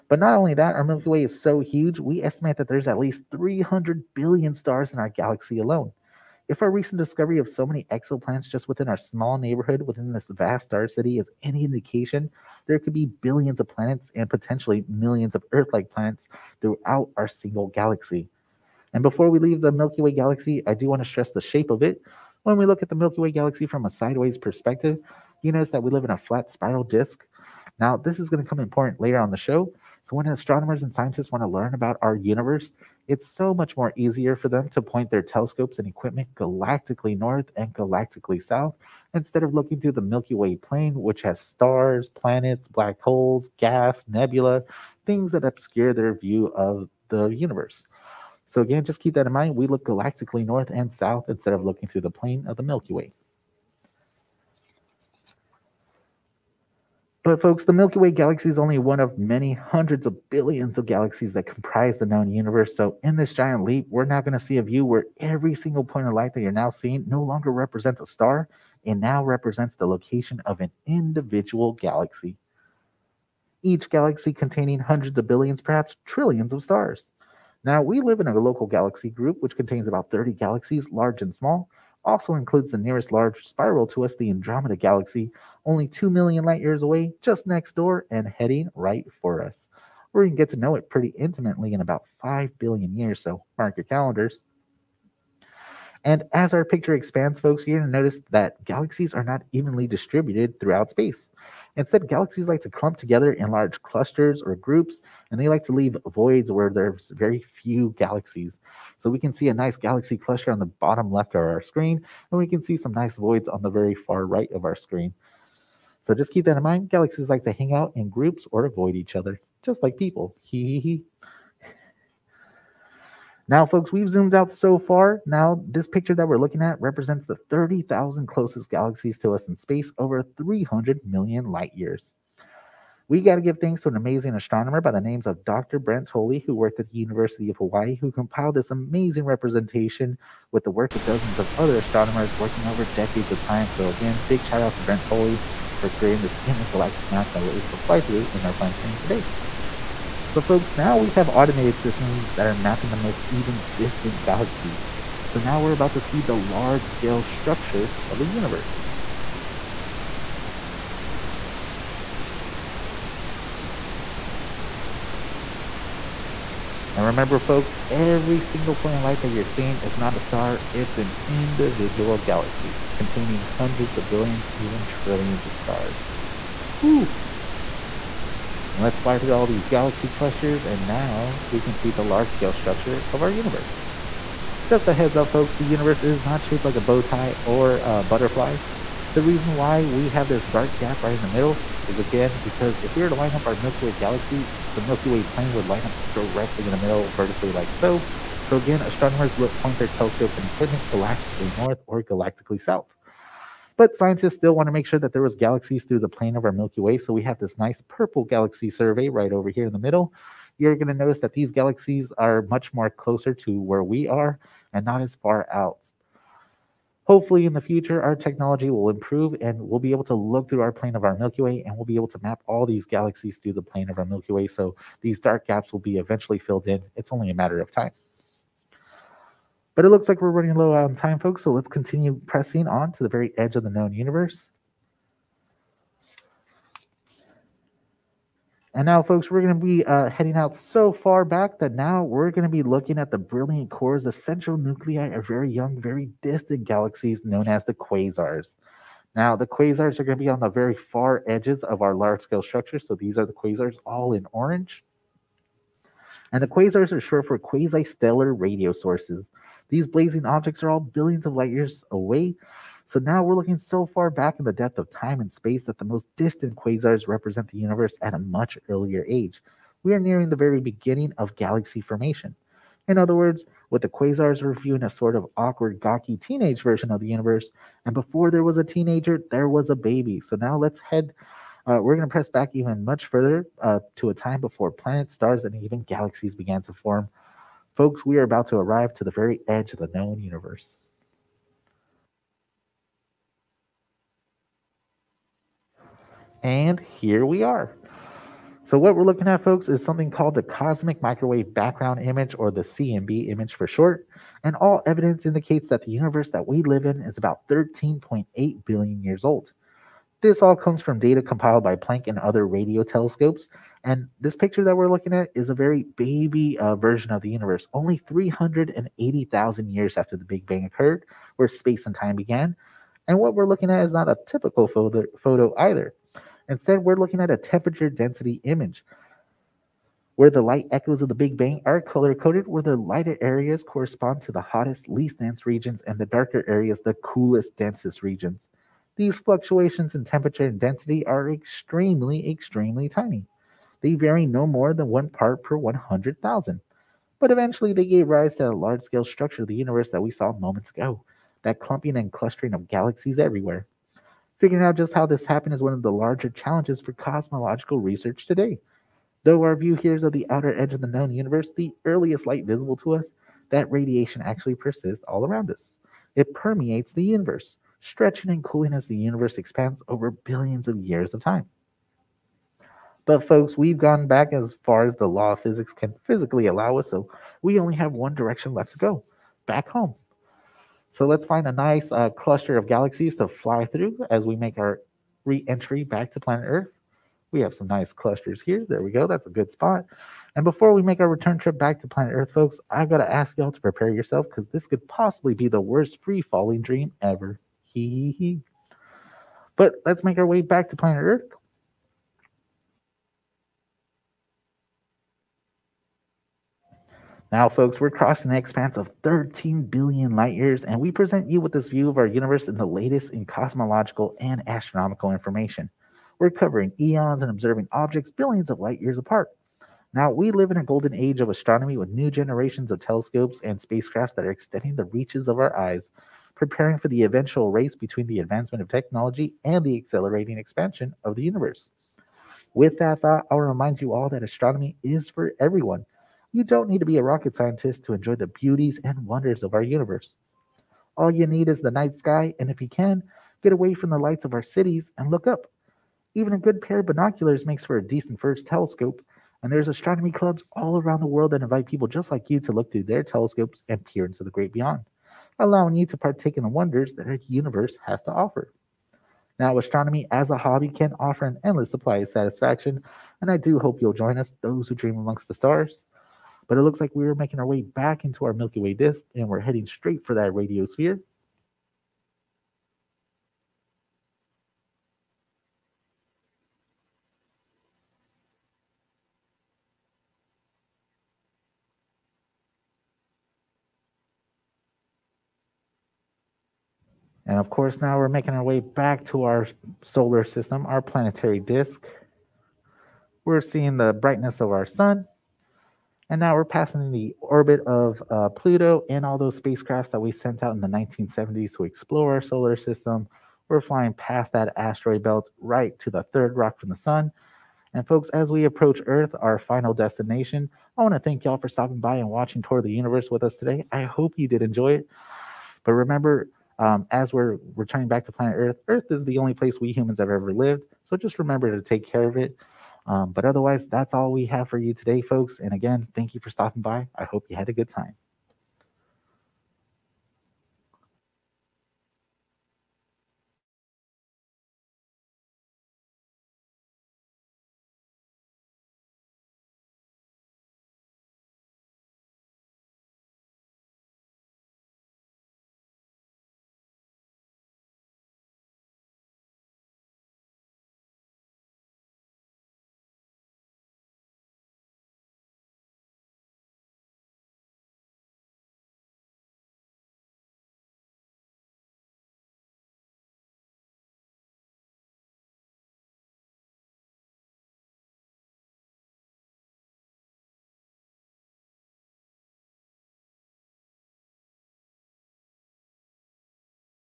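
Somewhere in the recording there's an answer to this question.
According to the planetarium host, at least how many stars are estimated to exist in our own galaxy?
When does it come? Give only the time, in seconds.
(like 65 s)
3 s.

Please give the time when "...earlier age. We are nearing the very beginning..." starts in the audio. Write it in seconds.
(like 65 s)
268 s.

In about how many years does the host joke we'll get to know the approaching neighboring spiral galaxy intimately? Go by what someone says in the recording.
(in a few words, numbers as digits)
5 billion years.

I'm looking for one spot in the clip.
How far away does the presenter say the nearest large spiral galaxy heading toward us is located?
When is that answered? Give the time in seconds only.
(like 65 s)
85 s.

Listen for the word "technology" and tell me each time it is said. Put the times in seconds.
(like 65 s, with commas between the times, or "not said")
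218 s, 428 s.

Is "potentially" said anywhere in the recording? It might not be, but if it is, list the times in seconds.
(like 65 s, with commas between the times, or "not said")
14 s.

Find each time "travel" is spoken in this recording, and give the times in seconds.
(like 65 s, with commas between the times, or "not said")
not said.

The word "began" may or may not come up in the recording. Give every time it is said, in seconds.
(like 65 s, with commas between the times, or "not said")
286 s, 322 s.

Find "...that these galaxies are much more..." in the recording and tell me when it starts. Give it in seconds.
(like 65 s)
211 s.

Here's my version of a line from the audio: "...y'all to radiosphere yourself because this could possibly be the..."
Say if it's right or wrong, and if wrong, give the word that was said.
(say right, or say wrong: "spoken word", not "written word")
wrong: "prepare", not "radiosphere".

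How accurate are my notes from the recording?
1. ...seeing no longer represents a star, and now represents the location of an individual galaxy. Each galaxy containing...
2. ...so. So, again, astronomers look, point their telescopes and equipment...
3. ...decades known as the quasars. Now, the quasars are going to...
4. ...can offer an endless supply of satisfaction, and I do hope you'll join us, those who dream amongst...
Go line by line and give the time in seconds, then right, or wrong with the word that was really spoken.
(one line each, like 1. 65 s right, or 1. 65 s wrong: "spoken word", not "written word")
1. 66 s right
2. 197 s right
3. 246 s wrong: "galaxies", not "decades"
4. 460 s right.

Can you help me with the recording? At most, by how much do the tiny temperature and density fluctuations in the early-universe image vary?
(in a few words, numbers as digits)
1 part per 100,000.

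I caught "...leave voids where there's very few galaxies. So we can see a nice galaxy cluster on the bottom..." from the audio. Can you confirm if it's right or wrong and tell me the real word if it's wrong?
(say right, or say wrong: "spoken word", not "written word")
right.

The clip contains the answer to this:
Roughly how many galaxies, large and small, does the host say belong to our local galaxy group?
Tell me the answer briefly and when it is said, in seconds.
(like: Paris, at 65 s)
30, at 79 s.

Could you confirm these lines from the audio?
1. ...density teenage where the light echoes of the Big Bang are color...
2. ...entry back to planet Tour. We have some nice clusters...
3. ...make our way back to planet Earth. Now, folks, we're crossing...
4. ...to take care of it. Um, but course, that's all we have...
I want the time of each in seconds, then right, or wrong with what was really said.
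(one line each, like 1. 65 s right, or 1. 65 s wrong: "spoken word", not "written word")
1. 327 s wrong: "image", not "teenage"
2. 385 s wrong: "Earth", not "Tour"
3. 400 s right
4. 521 s wrong: "otherwise", not "course".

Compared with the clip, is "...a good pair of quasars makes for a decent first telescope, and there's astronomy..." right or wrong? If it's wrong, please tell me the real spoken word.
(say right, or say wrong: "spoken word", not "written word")
wrong: "binoculars", not "quasars".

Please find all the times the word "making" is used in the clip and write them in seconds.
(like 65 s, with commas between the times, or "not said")
467 s, 488 s.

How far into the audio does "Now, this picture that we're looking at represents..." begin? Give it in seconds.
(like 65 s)
125 s.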